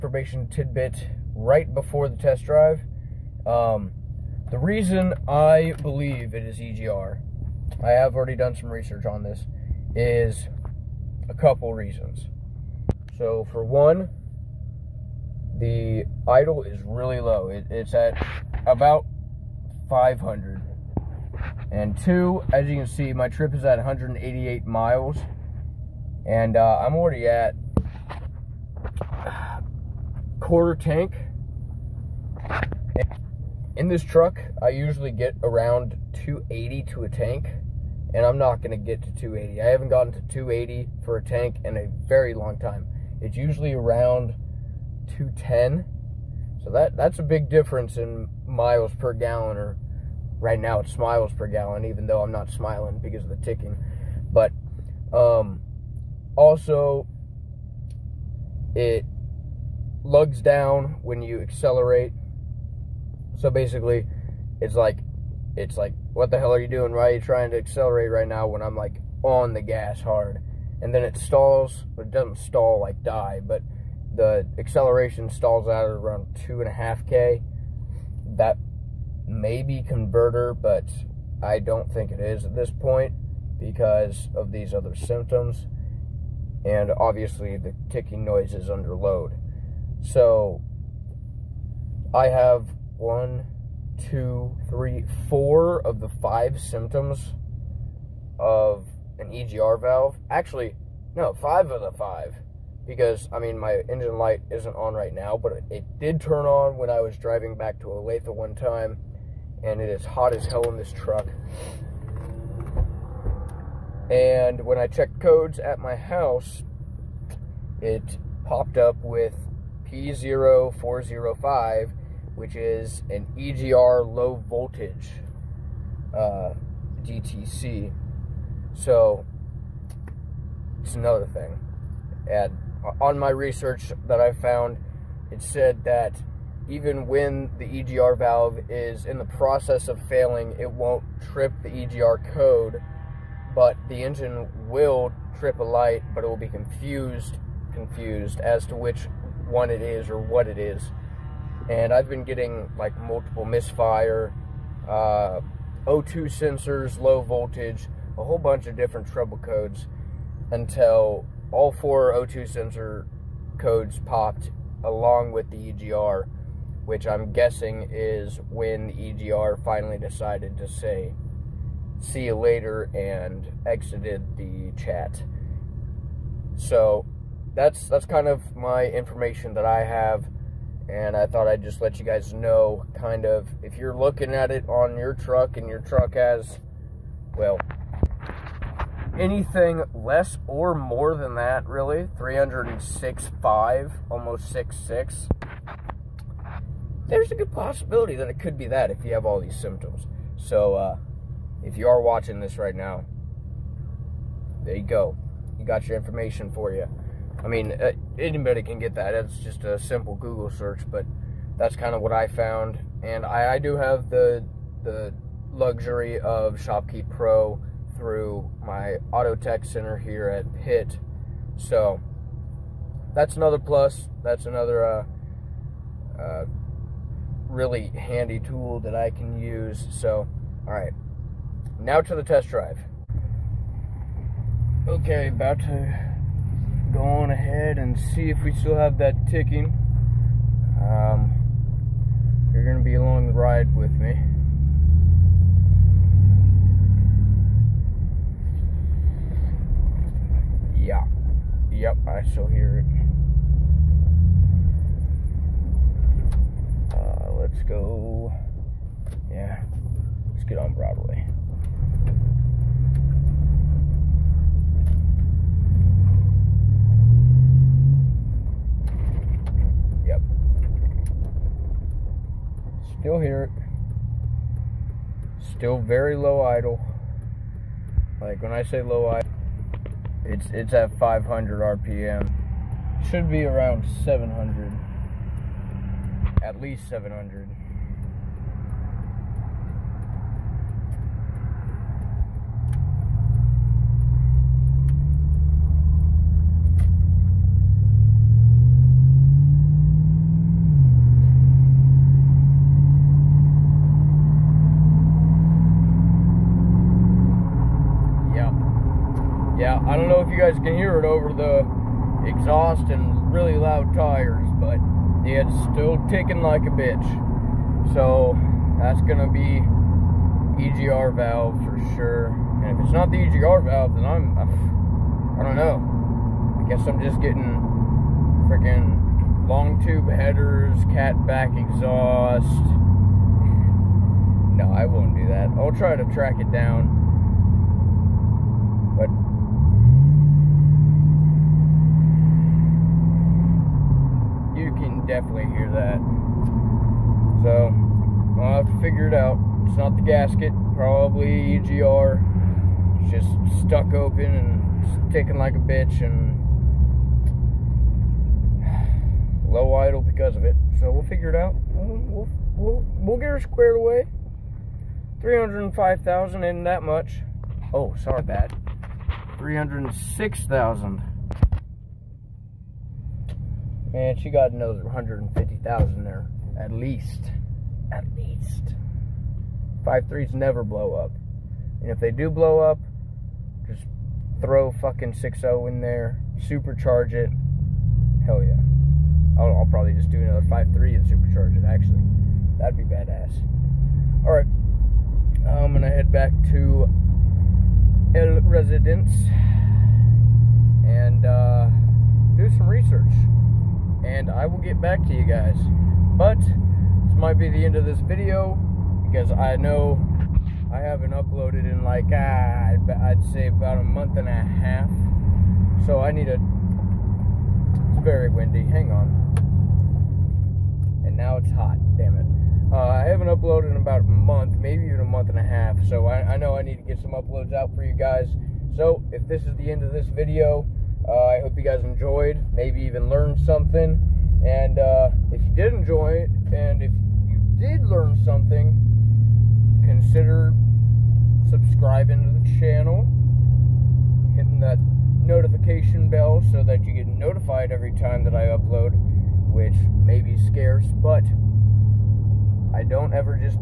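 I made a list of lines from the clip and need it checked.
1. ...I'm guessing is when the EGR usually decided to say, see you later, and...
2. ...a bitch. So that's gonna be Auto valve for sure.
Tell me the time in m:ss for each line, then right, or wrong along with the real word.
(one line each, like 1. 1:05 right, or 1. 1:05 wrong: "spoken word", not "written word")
1. 2:47 wrong: "finally", not "usually"
2. 5:16 wrong: "EGR", not "Auto".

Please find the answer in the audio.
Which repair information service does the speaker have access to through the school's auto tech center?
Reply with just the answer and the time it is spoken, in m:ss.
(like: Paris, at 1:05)
ShopKey Pro, at 3:36.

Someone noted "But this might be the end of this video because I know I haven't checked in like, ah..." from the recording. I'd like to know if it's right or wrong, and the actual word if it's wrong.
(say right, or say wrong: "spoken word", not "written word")
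wrong: "uploaded", not "checked".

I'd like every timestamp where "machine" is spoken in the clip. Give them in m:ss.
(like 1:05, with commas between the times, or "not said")
not said.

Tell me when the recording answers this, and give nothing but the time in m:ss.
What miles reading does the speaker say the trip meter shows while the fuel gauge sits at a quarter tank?
0:23.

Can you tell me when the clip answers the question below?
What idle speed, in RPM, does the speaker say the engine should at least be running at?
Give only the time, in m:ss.
4:46.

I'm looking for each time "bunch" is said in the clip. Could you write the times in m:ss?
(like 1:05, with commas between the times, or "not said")
2:38.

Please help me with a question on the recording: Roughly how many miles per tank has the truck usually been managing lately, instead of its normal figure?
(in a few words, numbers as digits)
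210.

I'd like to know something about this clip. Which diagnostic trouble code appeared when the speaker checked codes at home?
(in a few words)
P0405.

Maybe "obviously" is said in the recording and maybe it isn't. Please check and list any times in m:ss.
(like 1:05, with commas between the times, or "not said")
1:26.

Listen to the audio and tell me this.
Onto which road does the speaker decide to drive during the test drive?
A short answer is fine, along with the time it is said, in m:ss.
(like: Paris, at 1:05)
Broadway, at 4:20.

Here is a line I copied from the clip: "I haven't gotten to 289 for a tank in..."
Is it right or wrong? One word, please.
wrong.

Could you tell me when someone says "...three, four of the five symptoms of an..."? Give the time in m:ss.
1:34.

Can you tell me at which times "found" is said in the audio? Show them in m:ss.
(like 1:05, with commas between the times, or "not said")
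2:14, 3:32.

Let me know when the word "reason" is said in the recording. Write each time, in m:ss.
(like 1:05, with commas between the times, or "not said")
0:04, 0:11.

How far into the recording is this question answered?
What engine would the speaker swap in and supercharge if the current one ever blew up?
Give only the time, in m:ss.
6:25.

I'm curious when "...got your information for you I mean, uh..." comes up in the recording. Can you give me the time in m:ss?
3:25.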